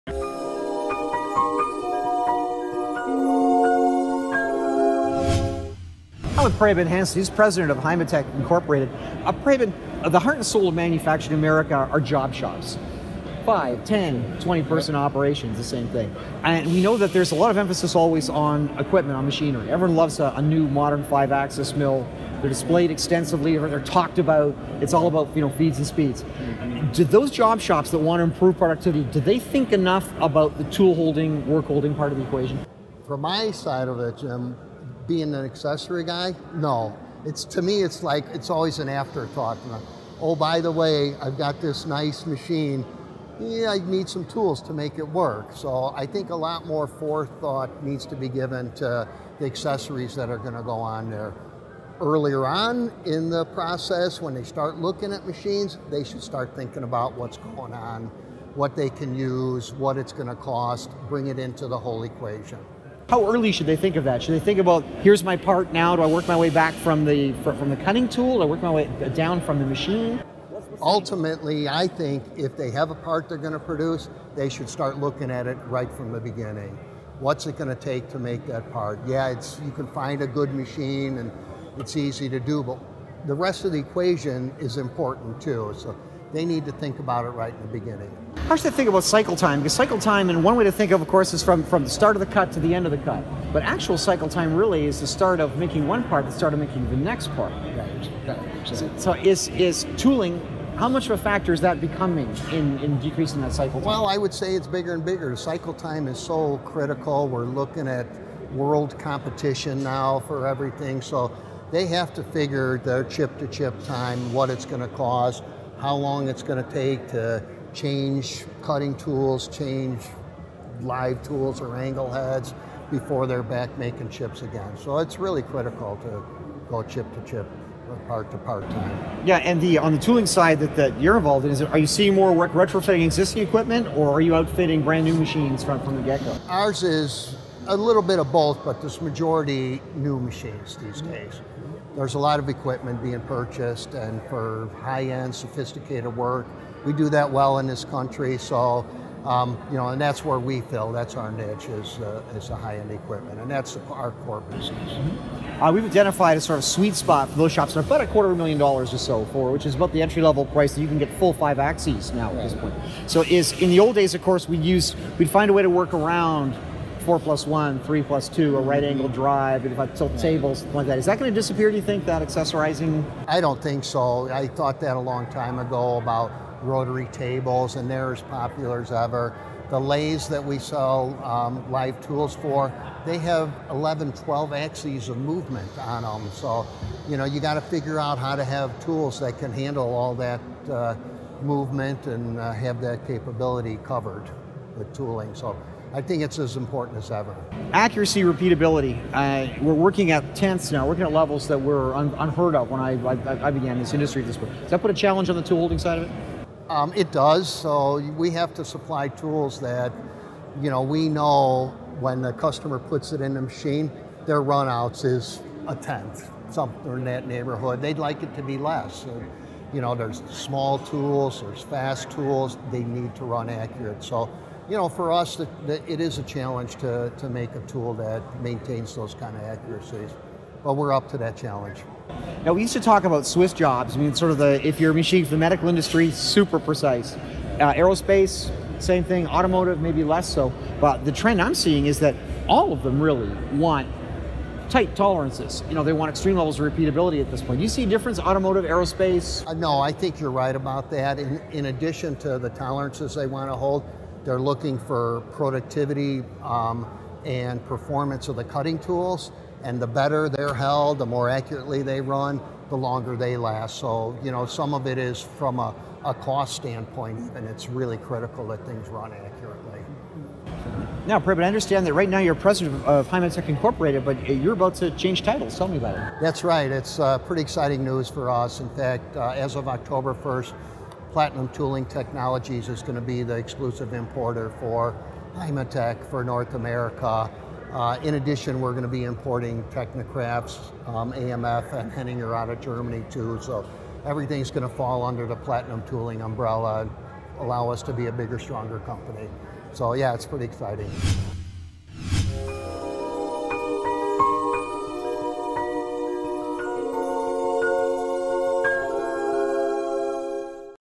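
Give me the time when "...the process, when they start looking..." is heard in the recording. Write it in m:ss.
0:53.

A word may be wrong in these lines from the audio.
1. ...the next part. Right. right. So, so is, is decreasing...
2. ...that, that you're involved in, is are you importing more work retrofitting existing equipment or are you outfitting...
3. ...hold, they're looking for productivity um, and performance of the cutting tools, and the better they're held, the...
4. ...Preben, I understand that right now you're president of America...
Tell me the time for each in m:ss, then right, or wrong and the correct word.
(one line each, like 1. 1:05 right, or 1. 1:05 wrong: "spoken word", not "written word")
1. 1:36 wrong: "tooling", not "decreasing"
2. 2:10 wrong: "seeing", not "importing"
3. 4:13 right
4. 4:31 wrong: "Heimatec", not "America".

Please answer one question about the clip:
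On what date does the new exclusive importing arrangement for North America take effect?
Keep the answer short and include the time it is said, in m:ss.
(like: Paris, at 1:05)
October 1st, at 4:39.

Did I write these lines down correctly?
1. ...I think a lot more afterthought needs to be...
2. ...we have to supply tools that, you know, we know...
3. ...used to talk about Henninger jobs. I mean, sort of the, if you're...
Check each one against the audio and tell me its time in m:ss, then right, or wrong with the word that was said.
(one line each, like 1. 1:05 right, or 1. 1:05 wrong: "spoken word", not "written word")
1. 0:45 wrong: "forethought", not "afterthought"
2. 3:28 right
3. 3:52 wrong: "Swiss", not "Henninger".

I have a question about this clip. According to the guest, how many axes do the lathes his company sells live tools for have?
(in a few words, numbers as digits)
11, 12.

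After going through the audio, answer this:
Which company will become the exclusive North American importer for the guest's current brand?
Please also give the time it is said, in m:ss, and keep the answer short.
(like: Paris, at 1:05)
Platinum Tooling Technologies, at 4:41.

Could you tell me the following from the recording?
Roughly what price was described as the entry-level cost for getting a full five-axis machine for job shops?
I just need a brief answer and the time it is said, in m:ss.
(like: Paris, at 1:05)
a quarter of a million dollars, at 2:38.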